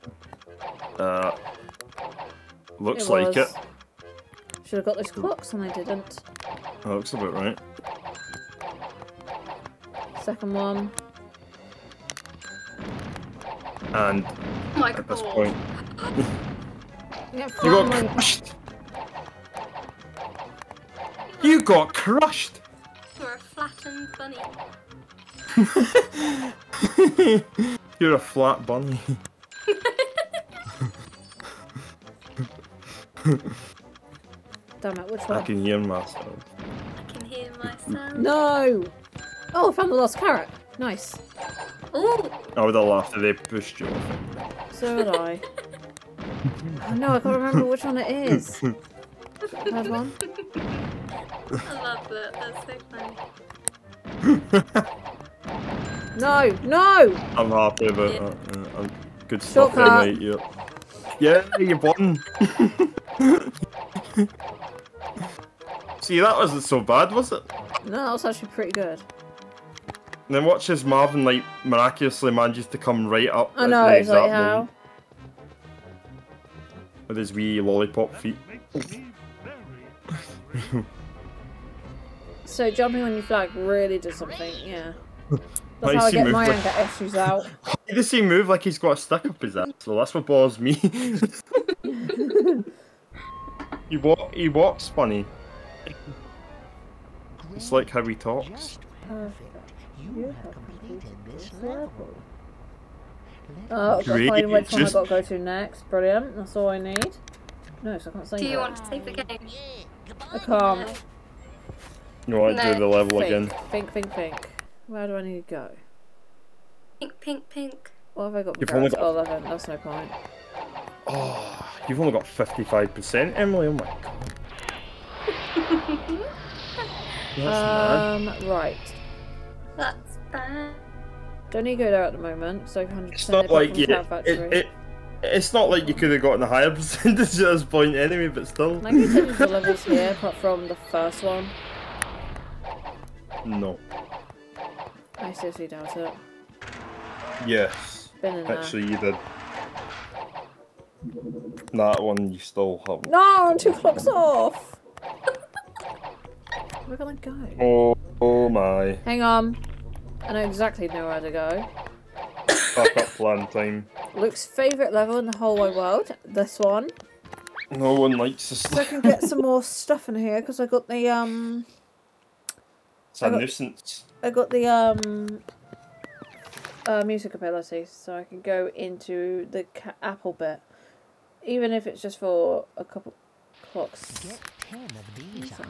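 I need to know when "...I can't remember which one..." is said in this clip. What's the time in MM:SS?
00:47.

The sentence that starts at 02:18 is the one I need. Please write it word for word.
Can I continue the levels here, apart from the first one?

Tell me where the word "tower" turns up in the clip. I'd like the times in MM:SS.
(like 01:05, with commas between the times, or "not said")
not said.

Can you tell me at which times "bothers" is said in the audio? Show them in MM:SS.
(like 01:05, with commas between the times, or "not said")
01:30.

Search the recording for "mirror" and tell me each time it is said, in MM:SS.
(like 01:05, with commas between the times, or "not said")
not said.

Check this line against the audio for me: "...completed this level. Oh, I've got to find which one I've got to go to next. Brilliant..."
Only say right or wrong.
right.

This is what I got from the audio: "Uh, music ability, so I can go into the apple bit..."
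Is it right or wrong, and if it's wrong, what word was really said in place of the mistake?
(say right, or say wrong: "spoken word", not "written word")
right.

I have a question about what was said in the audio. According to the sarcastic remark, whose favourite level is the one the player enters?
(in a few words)
Luke.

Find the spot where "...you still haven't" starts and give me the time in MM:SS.
02:32.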